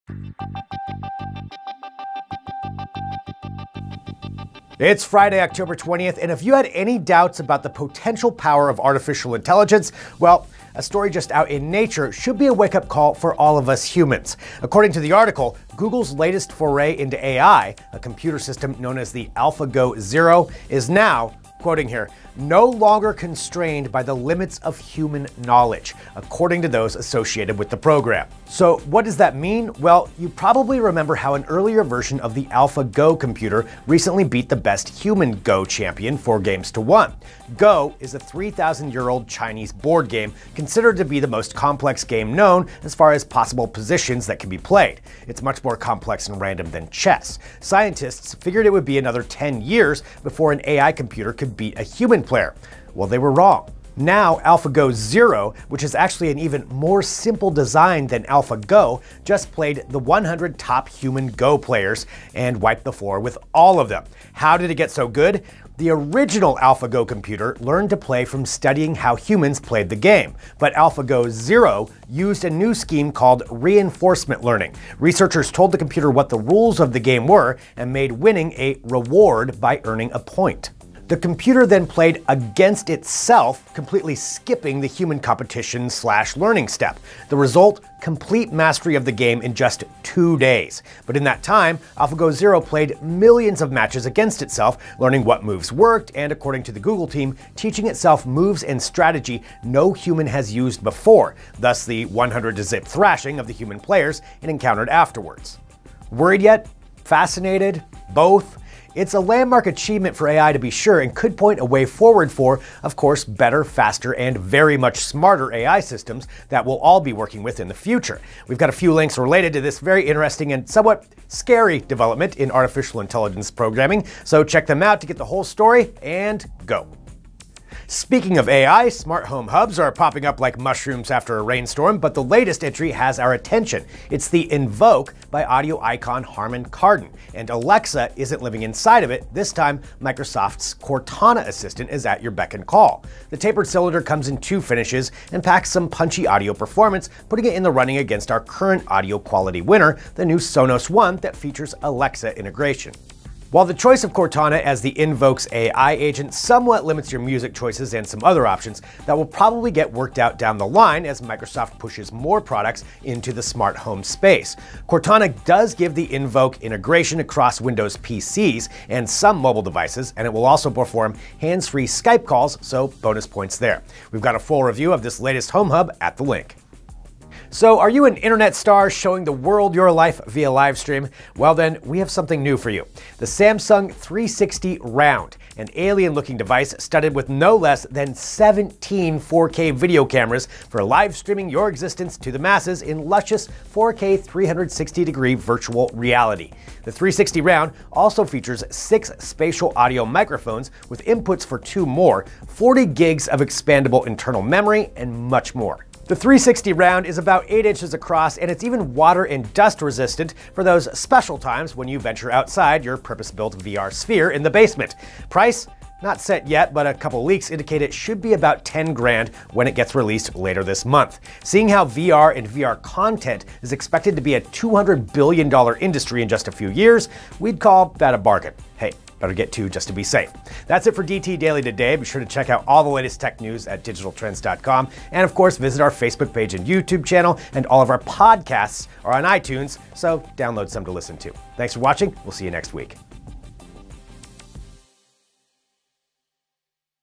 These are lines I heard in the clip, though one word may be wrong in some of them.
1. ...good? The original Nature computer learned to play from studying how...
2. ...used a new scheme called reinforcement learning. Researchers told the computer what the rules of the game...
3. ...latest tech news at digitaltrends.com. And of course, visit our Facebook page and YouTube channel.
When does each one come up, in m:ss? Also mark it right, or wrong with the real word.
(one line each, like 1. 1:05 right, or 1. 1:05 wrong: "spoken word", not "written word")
1. 1:05 wrong: "AlphaGo", not "Nature"
2. 1:12 right
3. 3:52 right.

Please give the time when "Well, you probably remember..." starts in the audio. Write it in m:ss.
0:29.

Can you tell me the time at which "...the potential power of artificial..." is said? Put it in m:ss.
0:07.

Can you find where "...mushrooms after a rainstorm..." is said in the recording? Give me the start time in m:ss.
2:10.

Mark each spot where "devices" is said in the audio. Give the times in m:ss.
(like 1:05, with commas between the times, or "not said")
2:49, 3:06.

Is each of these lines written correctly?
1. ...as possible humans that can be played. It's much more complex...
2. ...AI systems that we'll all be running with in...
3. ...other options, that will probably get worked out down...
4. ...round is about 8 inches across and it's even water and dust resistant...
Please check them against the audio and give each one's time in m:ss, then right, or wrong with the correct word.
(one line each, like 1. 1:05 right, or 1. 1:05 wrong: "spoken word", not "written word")
1. 0:43 wrong: "positions", not "humans"
2. 1:55 wrong: "working", not "running"
3. 2:38 right
4. 3:26 right.